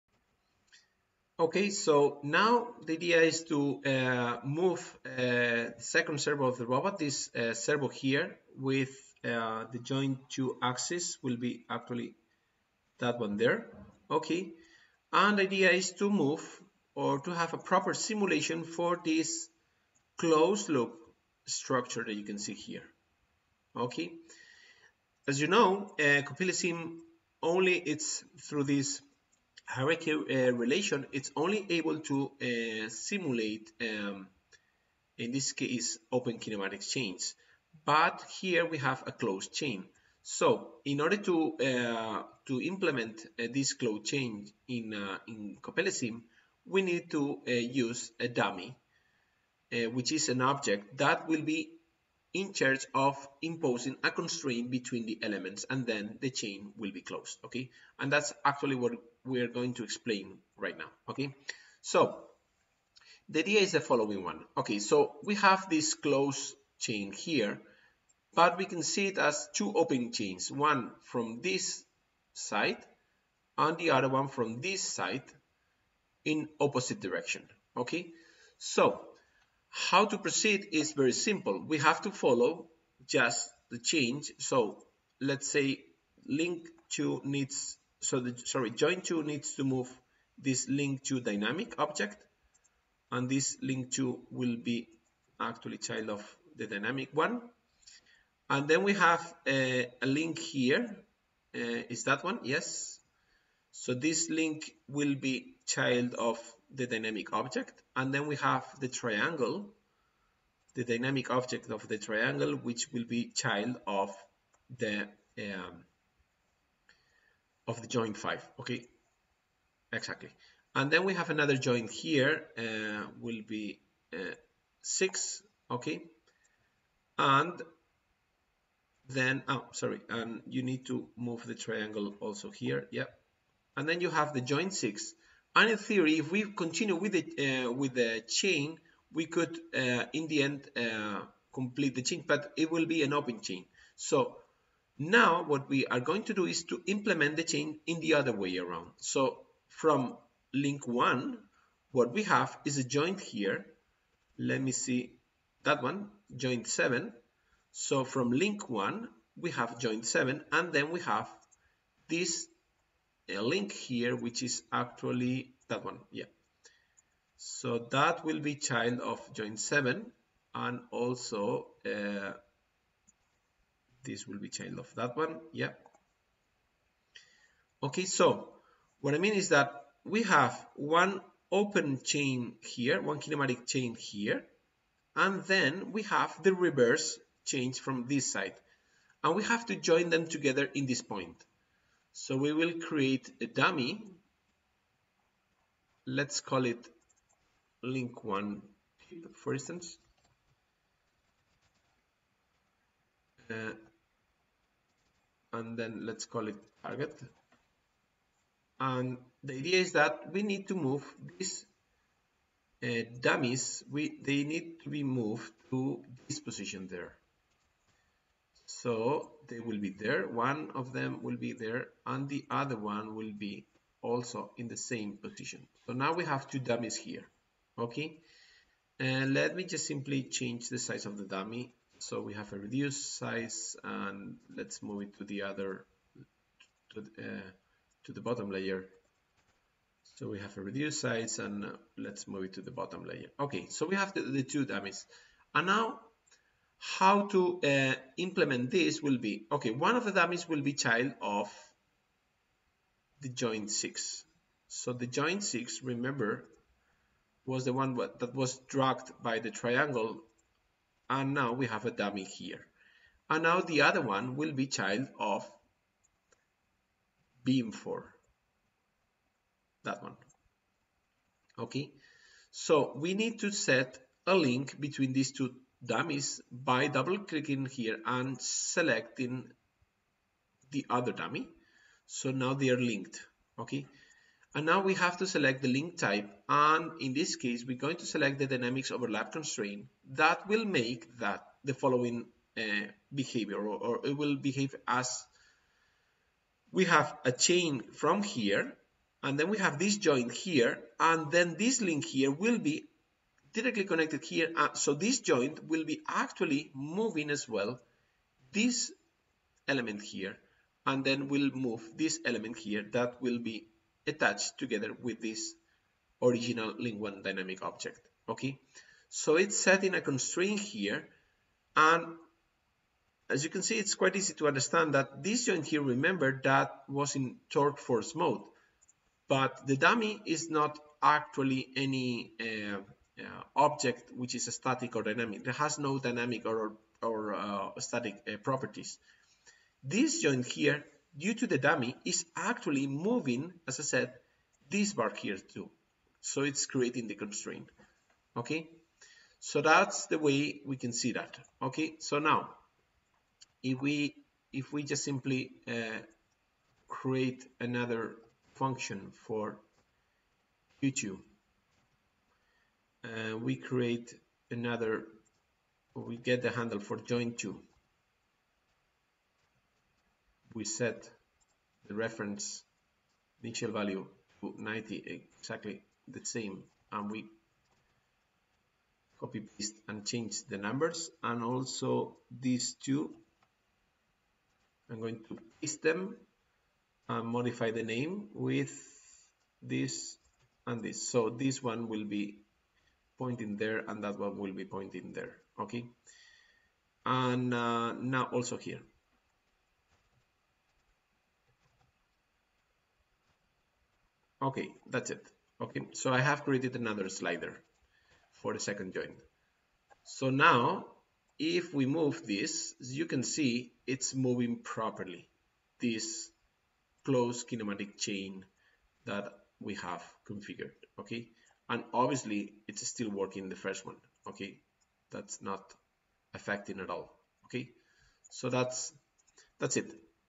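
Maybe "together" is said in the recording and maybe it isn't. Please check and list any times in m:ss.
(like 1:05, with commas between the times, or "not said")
3:10, 5:14.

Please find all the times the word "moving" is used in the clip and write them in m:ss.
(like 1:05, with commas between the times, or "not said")
5:06, 5:42, 6:54.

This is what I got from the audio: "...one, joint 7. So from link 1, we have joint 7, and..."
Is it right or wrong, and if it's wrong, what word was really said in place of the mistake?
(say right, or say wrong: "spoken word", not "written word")
right.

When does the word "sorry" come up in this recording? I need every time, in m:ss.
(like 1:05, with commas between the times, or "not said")
1:28, 2:09.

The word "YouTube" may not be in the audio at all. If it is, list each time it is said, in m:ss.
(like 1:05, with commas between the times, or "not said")
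6:00.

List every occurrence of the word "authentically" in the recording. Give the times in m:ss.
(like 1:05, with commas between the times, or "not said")
not said.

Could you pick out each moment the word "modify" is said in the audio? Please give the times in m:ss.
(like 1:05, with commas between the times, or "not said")
6:27.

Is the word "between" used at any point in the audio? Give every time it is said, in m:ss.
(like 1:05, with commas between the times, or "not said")
0:54, 4:34.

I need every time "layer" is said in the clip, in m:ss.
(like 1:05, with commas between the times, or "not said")
3:58, 4:03.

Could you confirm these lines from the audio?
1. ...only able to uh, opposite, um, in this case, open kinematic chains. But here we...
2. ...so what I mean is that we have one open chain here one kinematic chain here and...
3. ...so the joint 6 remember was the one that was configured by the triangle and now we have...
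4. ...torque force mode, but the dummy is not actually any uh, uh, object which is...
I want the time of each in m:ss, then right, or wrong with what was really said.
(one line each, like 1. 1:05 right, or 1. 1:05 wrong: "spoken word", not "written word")
1. 0:31 wrong: "simulate", not "opposite"
2. 2:58 right
3. 4:14 wrong: "dragged", not "configured"
4. 5:27 right.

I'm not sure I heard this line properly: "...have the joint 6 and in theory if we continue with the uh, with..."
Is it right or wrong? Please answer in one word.
right.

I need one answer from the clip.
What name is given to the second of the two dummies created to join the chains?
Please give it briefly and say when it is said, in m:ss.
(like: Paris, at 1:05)
target, at 3:26.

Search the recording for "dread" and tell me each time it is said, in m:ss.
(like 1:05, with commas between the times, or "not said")
not said.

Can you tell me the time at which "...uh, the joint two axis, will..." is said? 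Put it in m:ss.
0:09.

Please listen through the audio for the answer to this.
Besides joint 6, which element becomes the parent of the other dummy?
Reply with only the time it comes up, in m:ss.
4:27.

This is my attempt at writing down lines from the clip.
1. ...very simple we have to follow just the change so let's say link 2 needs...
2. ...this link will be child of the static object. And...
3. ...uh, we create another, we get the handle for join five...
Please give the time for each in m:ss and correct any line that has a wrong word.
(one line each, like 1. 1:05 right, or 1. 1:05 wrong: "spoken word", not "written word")
1. 1:20 right
2. 1:43 wrong: "dynamic", not "static"
3. 6:03 wrong: "two", not "five".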